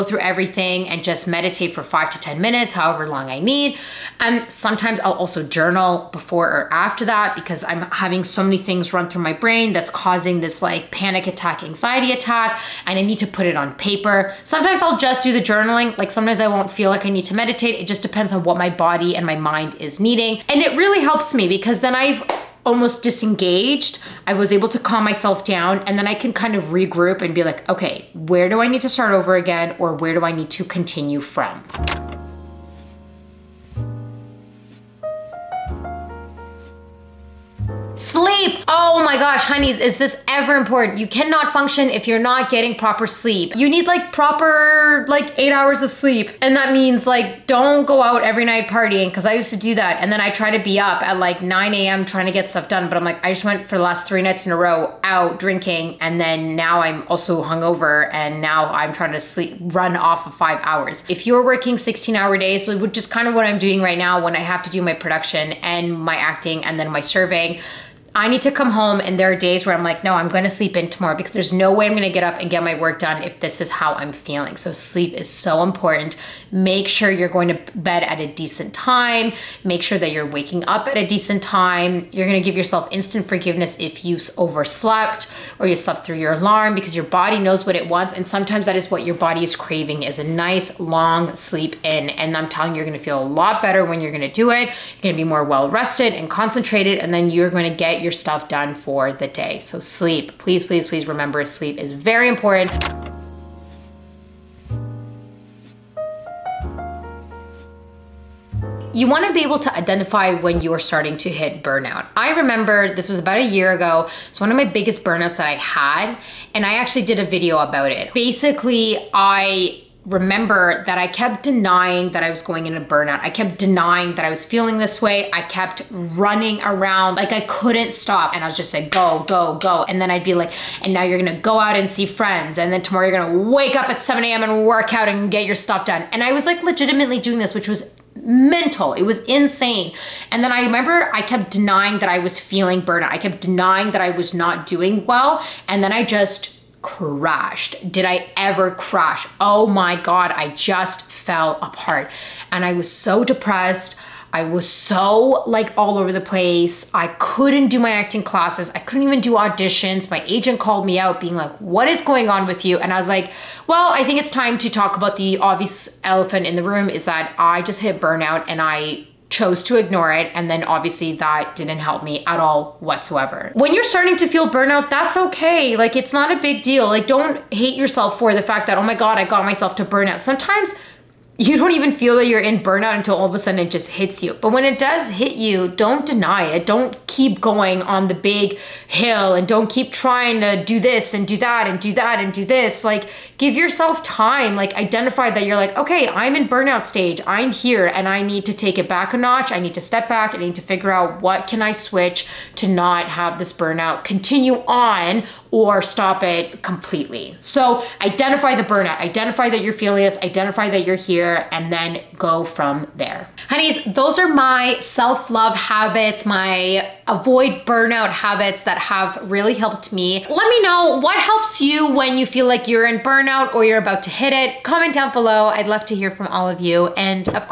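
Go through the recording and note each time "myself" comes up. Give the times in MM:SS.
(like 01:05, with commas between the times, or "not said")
00:25, 02:59.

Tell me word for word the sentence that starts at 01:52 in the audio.
I remember this was about a year ago.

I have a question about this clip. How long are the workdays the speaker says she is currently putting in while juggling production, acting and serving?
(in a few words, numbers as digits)
16 hours.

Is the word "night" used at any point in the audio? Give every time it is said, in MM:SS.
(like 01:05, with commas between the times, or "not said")
00:48, 00:54.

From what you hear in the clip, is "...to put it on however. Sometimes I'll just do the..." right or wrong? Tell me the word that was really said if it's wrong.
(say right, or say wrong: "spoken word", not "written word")
wrong: "paper", not "however".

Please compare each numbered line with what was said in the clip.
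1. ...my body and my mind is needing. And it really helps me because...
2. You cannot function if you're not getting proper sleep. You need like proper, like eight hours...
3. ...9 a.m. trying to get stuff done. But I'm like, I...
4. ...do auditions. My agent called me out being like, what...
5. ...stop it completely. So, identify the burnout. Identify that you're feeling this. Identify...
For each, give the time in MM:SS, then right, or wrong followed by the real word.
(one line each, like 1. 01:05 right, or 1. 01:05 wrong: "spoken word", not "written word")
1. 00:18 right
2. 00:40 right
3. 00:51 right
4. 02:39 right
5. 03:25 right.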